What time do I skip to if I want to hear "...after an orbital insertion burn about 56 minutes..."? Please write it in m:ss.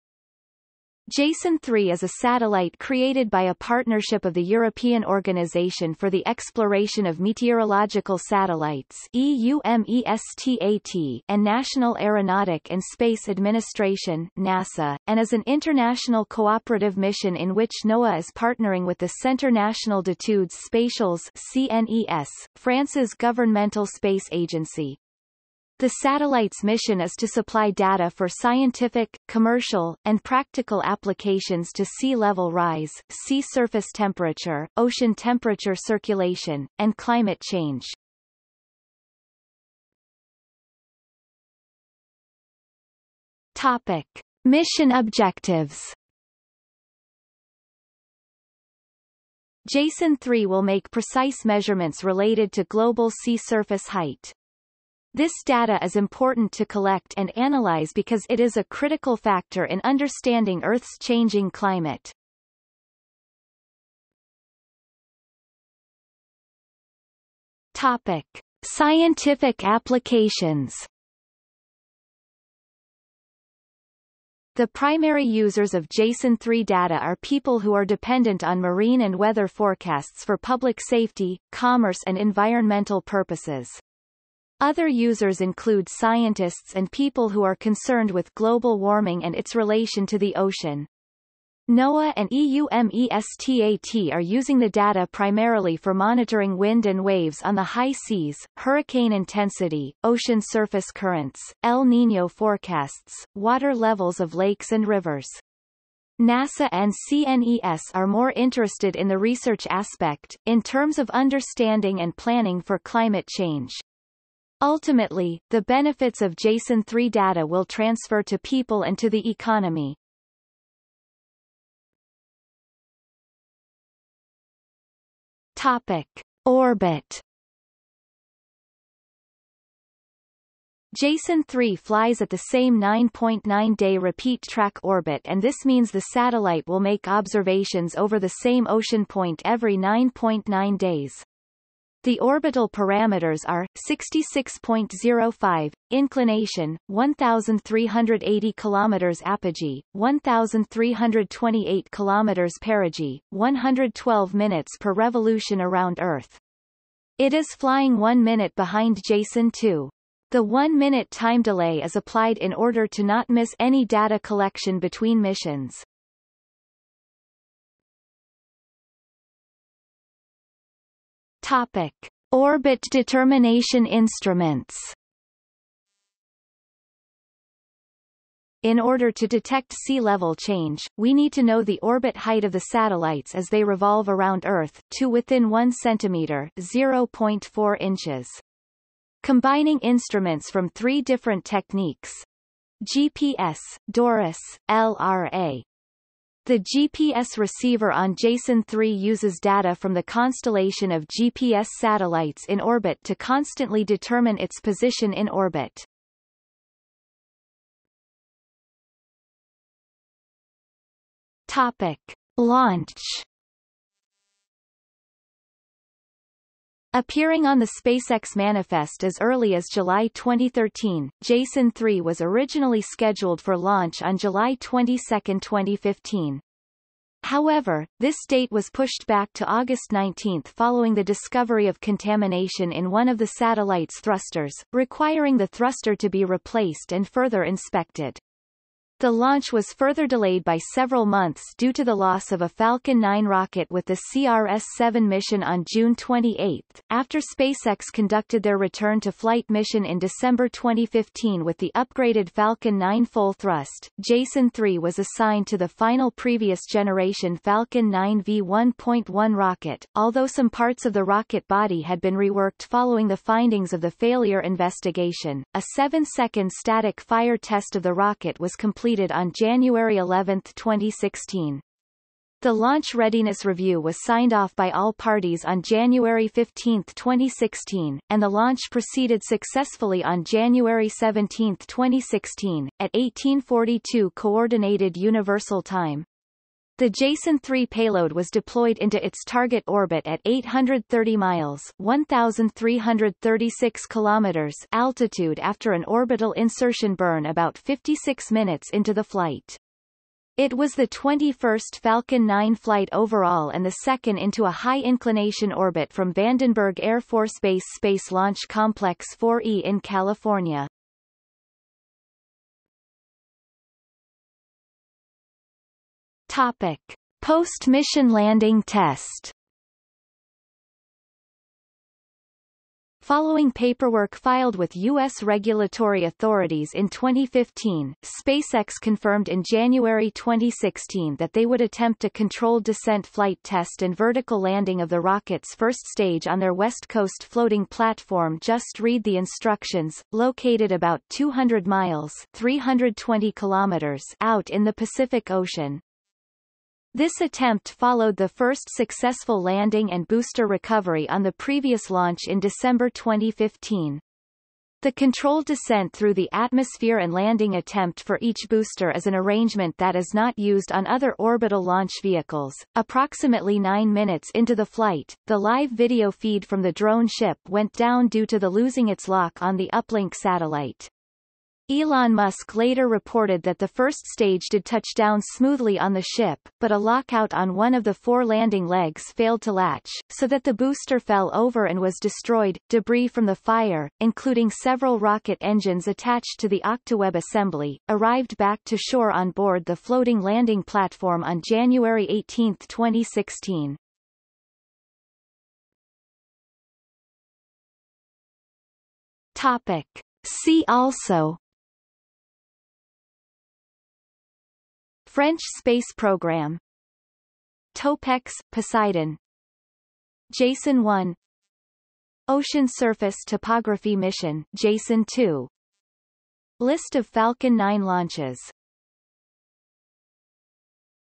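4:55.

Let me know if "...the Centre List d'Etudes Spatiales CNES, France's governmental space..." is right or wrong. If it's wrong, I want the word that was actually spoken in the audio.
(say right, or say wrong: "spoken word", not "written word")
wrong: "National", not "List".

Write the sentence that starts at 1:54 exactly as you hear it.
Ultimately, the benefits of Jason 3 data will transfer to people and to the economy.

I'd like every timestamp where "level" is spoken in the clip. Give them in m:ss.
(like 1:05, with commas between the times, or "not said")
0:32, 1:43, 2:59.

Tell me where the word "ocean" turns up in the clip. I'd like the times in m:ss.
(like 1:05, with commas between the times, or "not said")
0:34, 1:30, 1:40, 2:18, 5:45, 6:52.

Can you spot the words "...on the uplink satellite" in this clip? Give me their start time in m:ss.
6:09.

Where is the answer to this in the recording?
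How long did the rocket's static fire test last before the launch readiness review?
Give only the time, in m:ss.
4:25.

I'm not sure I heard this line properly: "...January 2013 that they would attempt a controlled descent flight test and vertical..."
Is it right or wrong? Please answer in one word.
wrong.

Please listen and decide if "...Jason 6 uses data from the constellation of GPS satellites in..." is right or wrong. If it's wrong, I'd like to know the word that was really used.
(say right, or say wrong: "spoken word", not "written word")
wrong: "3", not "6".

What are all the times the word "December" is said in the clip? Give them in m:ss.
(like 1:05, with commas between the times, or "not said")
4:09, 5:52.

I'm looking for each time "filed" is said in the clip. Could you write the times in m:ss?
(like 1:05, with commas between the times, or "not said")
5:24.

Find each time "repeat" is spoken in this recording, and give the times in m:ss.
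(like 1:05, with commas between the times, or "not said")
2:13.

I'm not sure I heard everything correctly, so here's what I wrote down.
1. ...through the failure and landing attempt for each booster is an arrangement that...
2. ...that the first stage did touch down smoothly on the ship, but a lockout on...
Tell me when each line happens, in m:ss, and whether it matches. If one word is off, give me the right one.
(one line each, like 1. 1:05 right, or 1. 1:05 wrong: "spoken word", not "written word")
1. 5:55 wrong: "atmosphere", not "failure"
2. 6:13 right.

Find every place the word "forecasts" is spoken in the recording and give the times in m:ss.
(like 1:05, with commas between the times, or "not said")
1:19, 1:42.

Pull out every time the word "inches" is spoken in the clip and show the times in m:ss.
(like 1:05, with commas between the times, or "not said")
3:07.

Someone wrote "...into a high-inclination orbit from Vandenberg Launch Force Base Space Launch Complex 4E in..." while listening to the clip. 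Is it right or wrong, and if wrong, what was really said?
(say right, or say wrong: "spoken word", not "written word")
wrong: "Air", not "Launch".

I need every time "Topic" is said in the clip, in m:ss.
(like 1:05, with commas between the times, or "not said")
0:43, 1:07, 2:05, 2:51, 3:31, 5:16, 6:39.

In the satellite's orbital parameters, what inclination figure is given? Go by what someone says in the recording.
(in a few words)
66.05.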